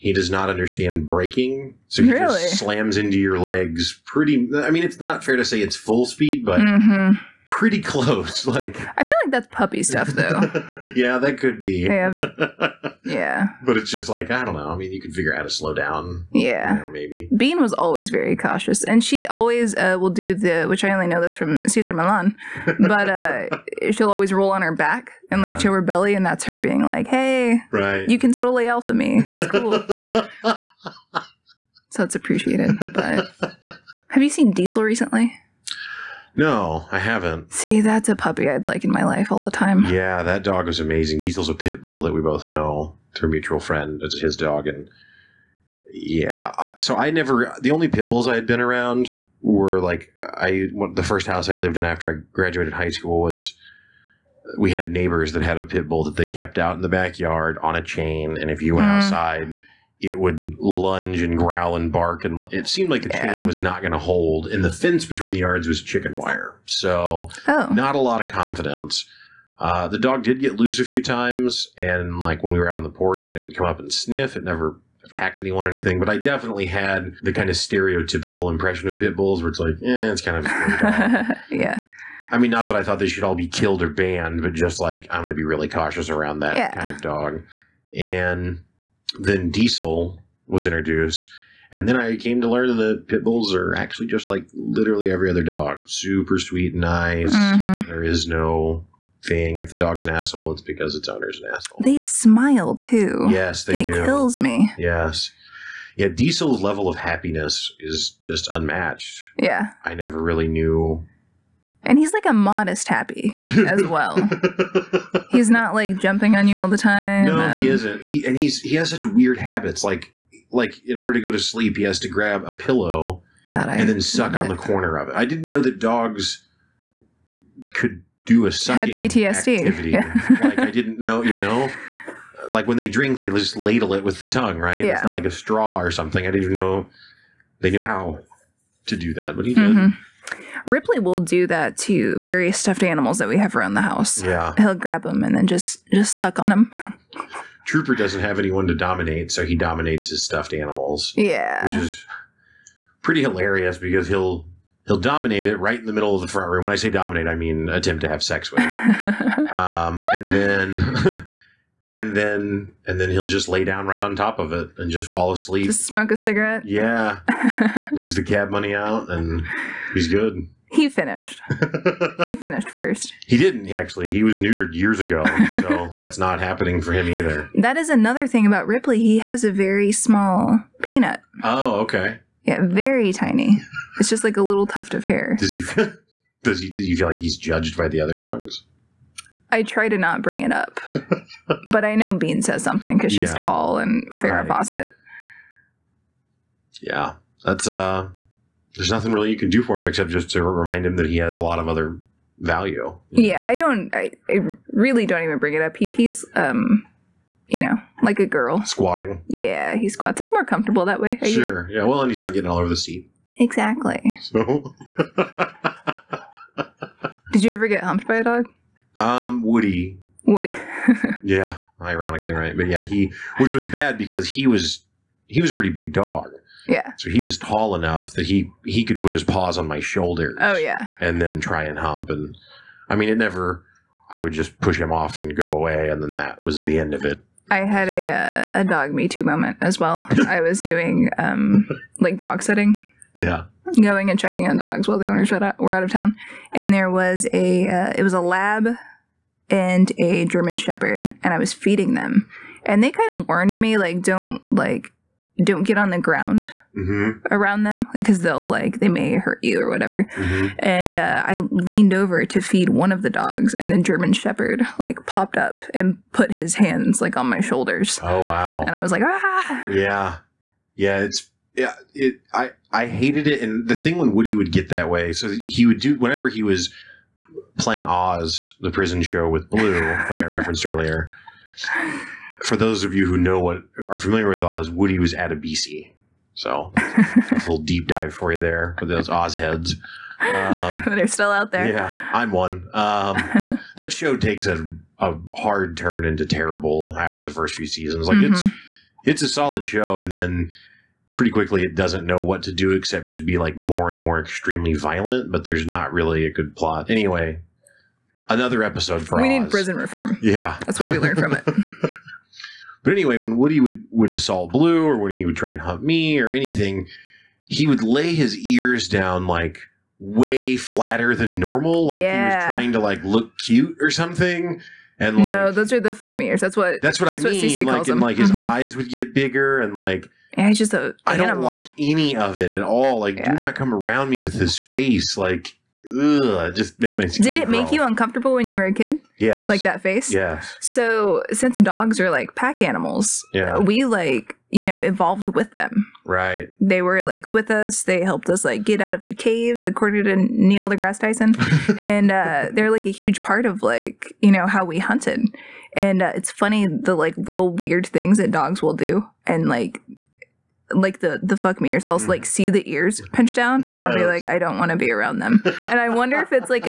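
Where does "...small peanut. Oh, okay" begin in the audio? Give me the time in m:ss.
2:59.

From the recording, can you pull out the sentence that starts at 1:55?
he's not like jumping on you all the time.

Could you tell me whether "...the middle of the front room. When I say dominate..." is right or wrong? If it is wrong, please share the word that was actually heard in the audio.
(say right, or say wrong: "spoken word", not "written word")
right.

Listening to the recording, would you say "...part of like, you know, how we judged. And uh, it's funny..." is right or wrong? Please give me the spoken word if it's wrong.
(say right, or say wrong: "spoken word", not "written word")
wrong: "hunted", not "judged".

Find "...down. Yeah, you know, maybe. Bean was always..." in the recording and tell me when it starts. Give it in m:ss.
0:15.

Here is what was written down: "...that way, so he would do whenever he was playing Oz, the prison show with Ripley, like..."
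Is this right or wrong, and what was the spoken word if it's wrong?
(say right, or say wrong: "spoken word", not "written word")
wrong: "Blue", not "Ripley".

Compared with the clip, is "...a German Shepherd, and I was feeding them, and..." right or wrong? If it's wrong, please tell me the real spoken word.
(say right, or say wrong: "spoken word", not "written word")
right.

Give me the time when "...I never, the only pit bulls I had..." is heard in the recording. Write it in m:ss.
0:46.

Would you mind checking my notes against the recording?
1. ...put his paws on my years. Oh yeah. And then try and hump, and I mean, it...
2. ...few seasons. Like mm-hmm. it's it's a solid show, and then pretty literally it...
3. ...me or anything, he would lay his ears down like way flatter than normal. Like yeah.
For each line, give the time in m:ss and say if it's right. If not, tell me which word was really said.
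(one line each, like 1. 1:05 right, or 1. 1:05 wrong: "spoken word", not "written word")
1. 3:49 wrong: "shoulders", not "years"
2. 4:57 wrong: "quickly", not "literally"
3. 5:15 right.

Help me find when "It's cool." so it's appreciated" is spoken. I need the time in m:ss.
0:29.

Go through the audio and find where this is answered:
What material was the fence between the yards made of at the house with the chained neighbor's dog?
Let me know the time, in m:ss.
1:05.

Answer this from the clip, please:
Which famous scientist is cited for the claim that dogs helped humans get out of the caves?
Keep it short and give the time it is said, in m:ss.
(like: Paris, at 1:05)
Neil deGrasse Tyson, at 5:50.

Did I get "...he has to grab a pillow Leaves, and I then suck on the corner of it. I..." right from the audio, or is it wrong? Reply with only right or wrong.
wrong.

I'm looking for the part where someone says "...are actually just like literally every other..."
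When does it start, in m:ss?
1:33.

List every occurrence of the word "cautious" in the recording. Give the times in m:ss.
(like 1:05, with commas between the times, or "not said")
0:18, 1:25.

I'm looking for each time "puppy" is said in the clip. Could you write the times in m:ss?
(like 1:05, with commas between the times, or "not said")
0:09, 0:38.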